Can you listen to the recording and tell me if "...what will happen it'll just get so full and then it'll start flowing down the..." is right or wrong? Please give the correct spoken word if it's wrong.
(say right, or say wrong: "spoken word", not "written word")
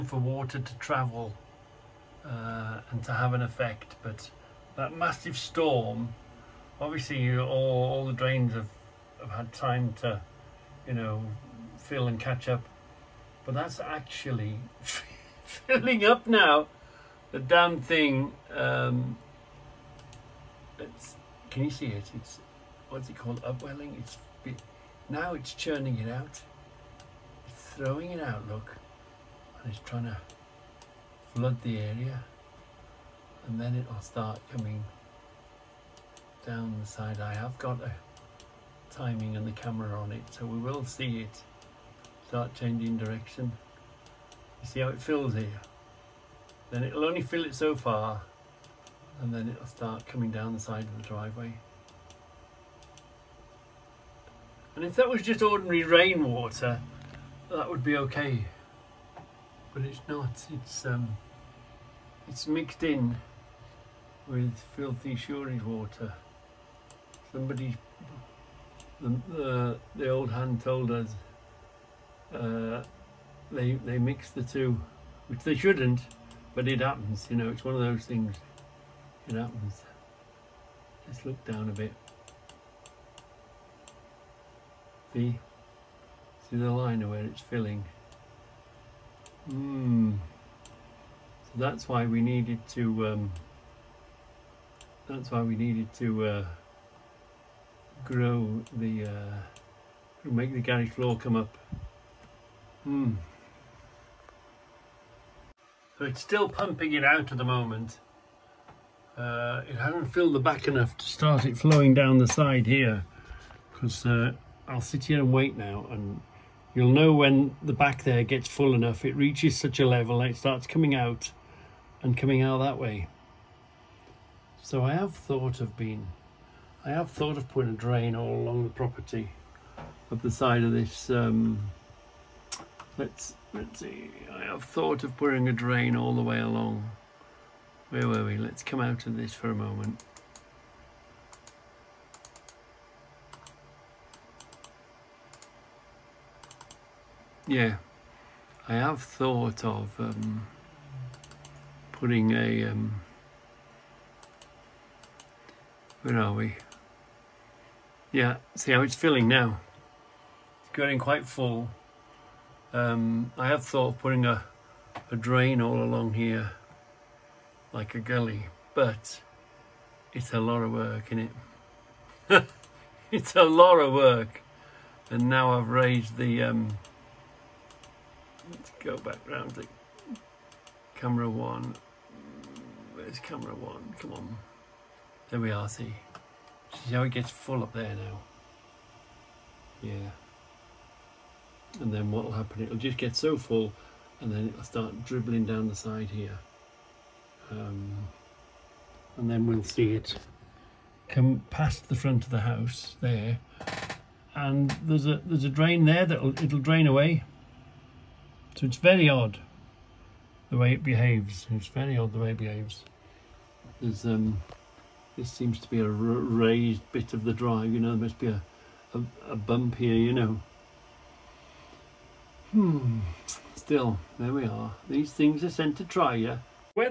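wrong: "dribbling", not "flowing".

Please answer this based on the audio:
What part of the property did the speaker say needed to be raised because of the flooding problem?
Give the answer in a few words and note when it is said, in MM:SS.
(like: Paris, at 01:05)
The garage floor, at 01:40.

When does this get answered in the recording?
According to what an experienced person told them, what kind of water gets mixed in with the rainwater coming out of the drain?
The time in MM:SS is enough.
01:05.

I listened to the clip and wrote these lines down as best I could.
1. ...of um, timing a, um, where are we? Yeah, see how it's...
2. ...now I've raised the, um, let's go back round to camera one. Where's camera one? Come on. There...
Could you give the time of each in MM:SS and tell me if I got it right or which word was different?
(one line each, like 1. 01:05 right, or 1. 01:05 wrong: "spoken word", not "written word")
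1. 02:29 wrong: "putting", not "timing"
2. 02:55 right.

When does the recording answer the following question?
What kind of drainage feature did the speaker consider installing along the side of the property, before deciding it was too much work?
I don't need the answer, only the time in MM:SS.
02:47.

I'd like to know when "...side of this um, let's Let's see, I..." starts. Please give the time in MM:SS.
02:10.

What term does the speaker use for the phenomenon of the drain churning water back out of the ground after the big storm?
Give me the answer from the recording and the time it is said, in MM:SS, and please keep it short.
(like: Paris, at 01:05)
Upwelling, at 00:23.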